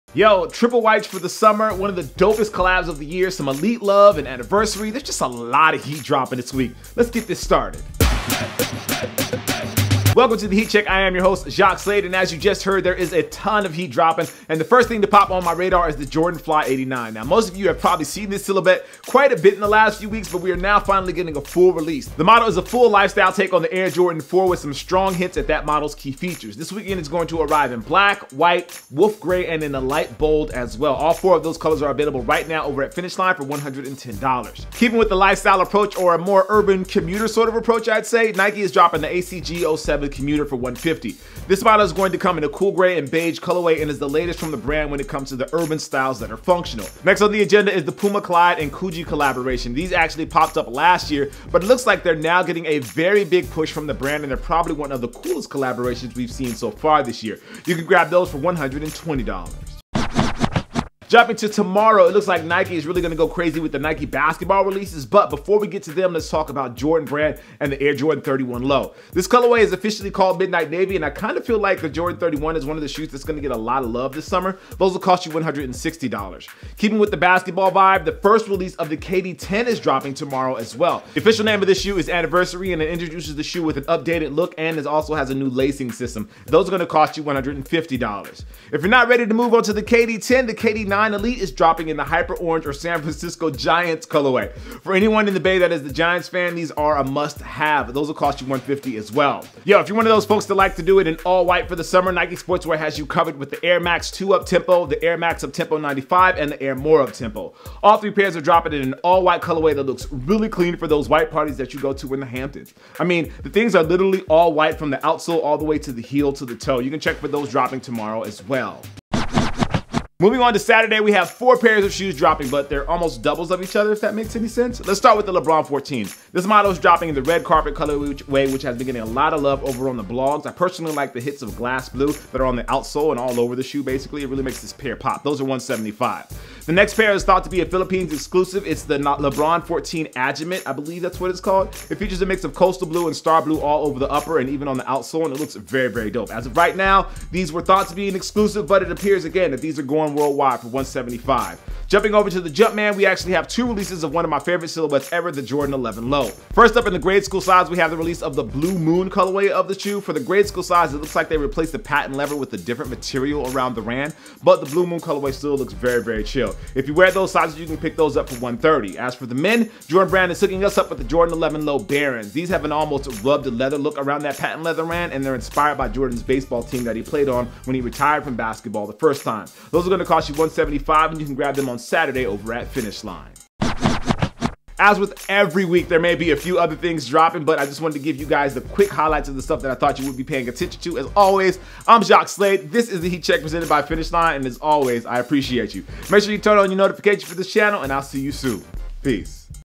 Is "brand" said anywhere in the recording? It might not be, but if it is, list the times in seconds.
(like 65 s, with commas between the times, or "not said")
44 s, 53 s, 67 s, 170 s.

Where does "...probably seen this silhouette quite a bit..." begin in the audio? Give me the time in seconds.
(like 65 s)
17 s.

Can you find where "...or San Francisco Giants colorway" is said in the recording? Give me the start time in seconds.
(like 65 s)
92 s.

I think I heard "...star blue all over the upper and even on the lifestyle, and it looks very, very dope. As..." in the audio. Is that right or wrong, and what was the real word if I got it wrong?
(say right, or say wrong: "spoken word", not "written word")
wrong: "outsole", not "lifestyle".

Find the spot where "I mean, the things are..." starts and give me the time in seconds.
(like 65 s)
112 s.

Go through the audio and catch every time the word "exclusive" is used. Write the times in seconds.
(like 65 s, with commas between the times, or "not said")
138 s, 148 s.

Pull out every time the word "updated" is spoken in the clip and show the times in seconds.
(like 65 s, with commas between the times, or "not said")
83 s.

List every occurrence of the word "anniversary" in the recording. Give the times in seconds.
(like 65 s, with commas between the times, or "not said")
4 s, 82 s.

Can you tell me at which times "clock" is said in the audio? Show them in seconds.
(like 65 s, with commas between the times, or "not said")
not said.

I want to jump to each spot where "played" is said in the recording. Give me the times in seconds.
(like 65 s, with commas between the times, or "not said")
177 s.